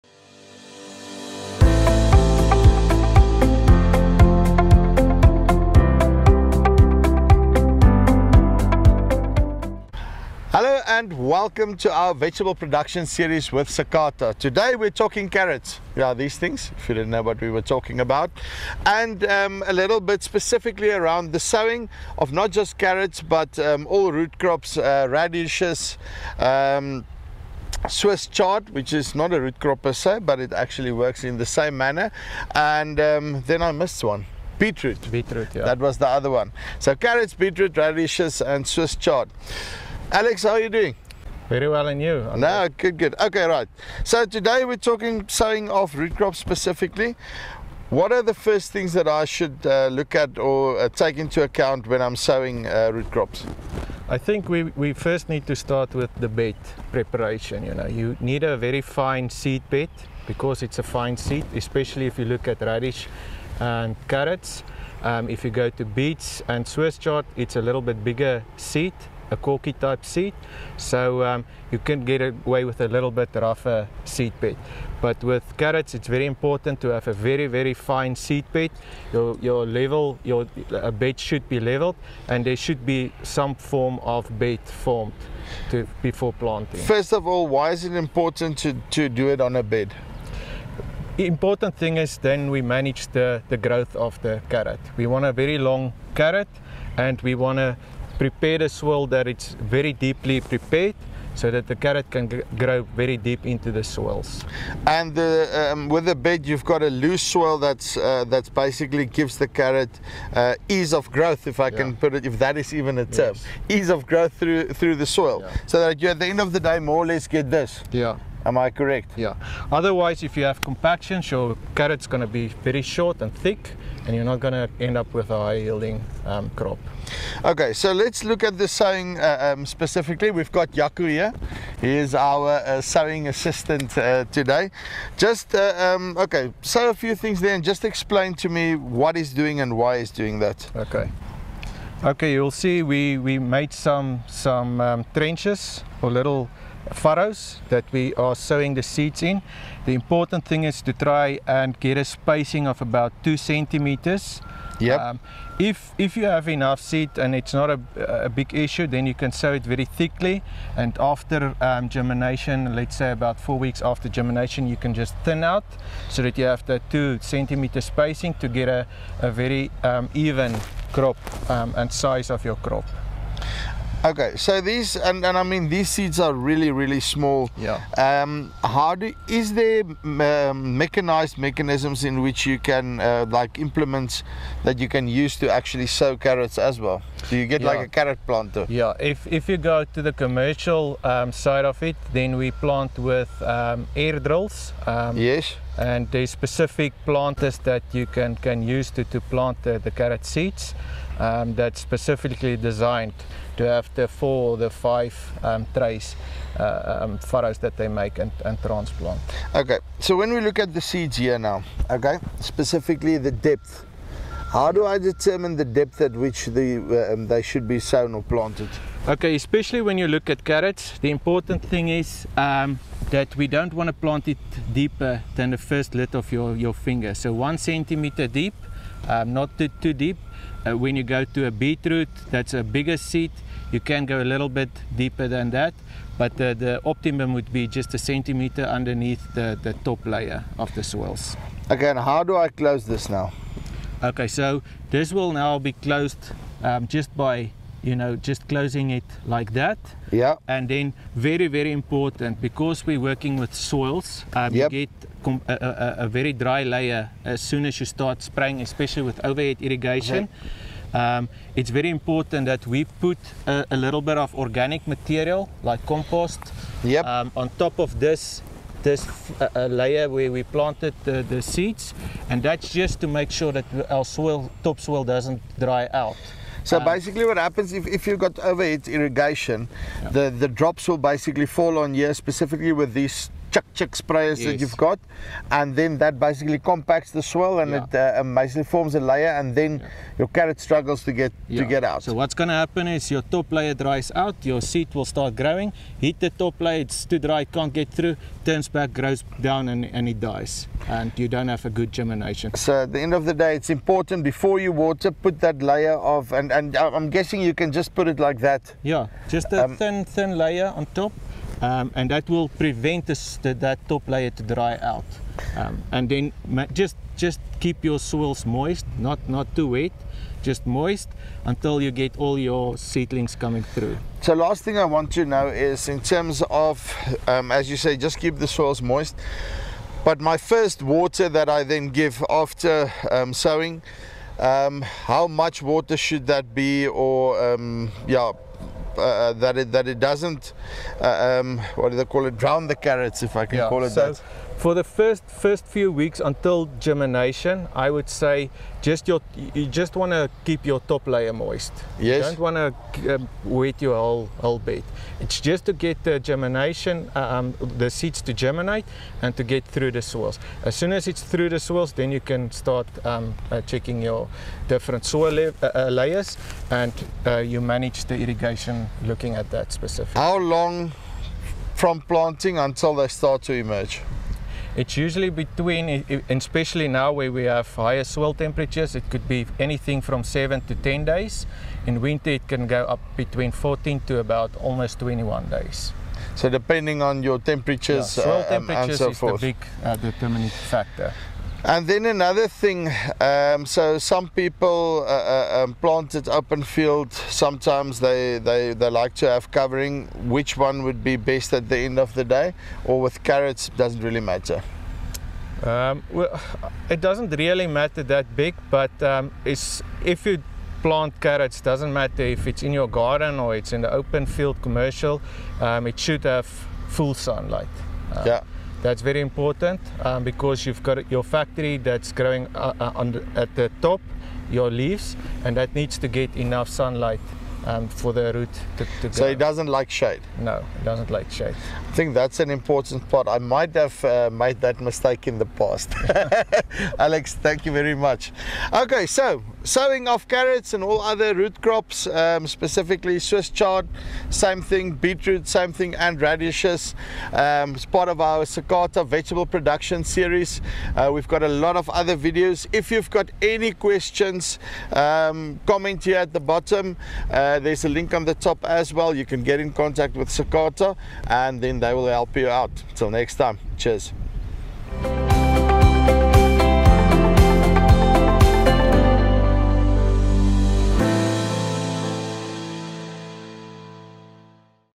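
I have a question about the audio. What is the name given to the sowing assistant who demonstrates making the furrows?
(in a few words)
Yaku.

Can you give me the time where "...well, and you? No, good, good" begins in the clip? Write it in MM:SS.
00:41.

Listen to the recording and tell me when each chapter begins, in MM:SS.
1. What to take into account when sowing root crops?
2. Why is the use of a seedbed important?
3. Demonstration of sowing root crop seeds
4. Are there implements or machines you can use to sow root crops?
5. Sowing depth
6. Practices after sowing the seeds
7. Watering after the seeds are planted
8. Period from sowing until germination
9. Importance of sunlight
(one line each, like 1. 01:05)
1. 00:47
2. 01:27
3. 02:08
4. 02:59
5. 03:30
6. 04:02
7. 05:24
8. 06:10
9. 06:30.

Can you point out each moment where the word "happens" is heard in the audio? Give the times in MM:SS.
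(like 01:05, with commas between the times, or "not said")
04:37, 04:52.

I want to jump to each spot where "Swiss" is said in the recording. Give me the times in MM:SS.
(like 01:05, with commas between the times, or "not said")
00:27, 00:38, 01:06, 07:23.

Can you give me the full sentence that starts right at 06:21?
In winter, it can go up between 14 to about almost 21 days.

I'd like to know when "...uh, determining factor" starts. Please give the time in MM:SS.
06:29.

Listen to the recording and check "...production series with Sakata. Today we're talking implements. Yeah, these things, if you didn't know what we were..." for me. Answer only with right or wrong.
wrong.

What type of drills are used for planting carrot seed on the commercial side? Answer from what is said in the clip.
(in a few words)
Air drills.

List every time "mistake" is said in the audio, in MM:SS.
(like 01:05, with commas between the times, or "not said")
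07:14.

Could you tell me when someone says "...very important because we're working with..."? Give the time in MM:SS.
04:11.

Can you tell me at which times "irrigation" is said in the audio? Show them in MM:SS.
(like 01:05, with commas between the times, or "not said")
04:19, 04:38, 06:08.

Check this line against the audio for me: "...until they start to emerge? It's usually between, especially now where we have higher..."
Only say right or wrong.
right.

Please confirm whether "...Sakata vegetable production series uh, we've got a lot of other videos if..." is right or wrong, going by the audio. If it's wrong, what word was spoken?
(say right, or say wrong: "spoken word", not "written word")
right.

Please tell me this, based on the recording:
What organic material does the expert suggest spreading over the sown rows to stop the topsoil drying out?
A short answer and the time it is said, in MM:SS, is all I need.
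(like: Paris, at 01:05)
Compost, at 04:25.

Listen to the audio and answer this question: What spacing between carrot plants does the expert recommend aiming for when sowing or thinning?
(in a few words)
2 centimeters.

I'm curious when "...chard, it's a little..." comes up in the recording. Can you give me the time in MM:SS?
01:06.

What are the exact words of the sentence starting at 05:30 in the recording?
But my first water that I then give after um, sowing, um, how much water should that be, or um, yeah?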